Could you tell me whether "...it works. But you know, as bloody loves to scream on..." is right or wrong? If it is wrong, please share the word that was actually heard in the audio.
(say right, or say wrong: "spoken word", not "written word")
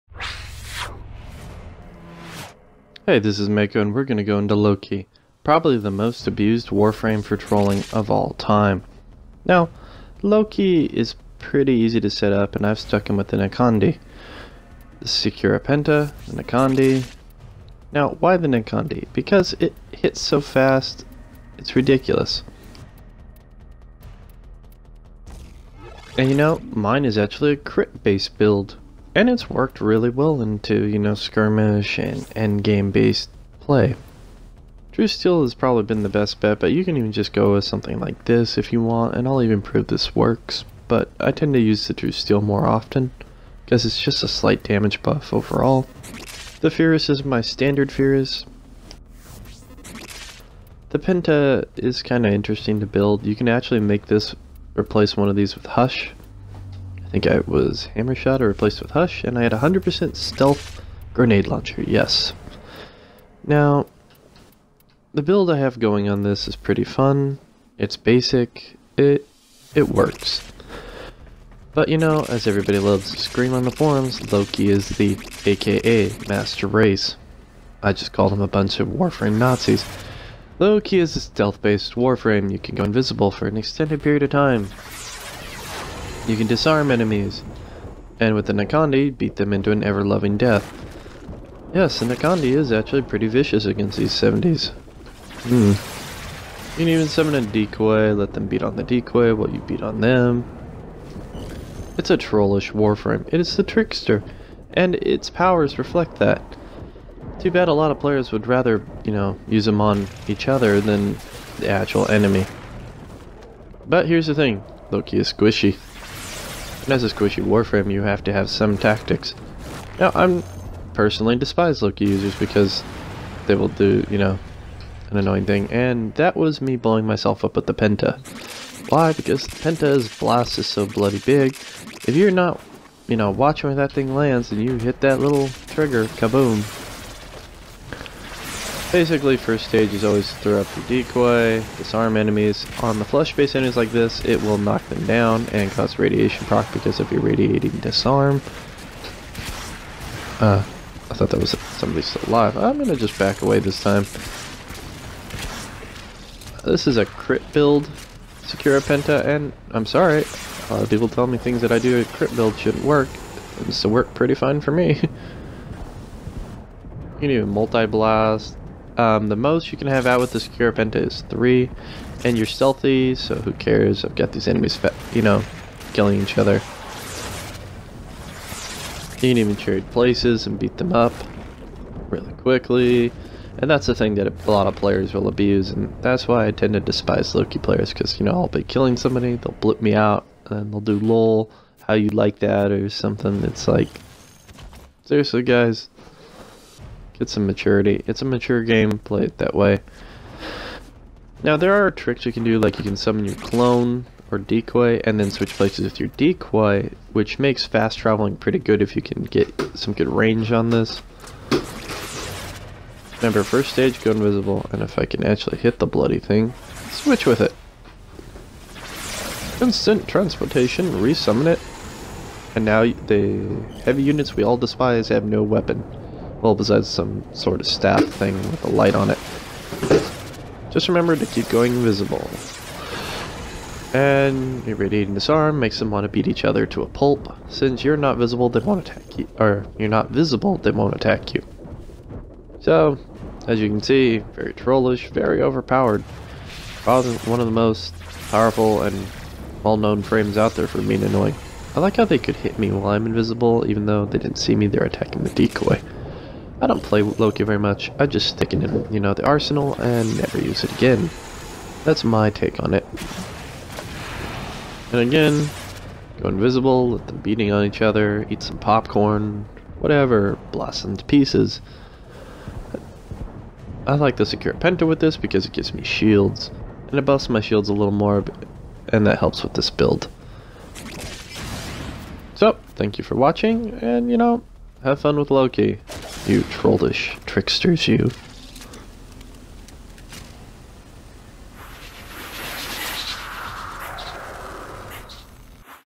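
wrong: "everybody", not "bloody".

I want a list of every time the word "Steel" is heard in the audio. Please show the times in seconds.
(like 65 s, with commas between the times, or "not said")
35 s, 42 s.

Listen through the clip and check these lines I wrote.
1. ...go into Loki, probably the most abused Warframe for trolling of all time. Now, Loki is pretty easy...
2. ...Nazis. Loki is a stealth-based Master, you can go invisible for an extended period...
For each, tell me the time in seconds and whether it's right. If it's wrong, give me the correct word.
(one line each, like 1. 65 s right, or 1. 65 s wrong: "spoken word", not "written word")
1. 4 s right
2. 79 s wrong: "Warframe", not "Master".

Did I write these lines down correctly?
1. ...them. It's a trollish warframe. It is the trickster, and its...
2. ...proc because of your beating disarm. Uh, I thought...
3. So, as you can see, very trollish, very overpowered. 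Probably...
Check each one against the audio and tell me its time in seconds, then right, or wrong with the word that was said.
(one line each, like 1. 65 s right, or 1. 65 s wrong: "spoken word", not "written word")
1. 100 s right
2. 146 s wrong: "radiating", not "beating"
3. 242 s right.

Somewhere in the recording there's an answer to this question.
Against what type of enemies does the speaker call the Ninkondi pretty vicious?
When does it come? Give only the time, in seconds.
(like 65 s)
94 s.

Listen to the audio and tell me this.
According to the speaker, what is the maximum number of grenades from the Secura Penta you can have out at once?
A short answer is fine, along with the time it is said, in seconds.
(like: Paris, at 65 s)
3, at 171 s.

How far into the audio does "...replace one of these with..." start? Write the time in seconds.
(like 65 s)
54 s.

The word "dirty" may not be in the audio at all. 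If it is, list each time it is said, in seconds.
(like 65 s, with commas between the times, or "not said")
not said.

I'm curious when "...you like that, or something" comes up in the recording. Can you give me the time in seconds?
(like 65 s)
191 s.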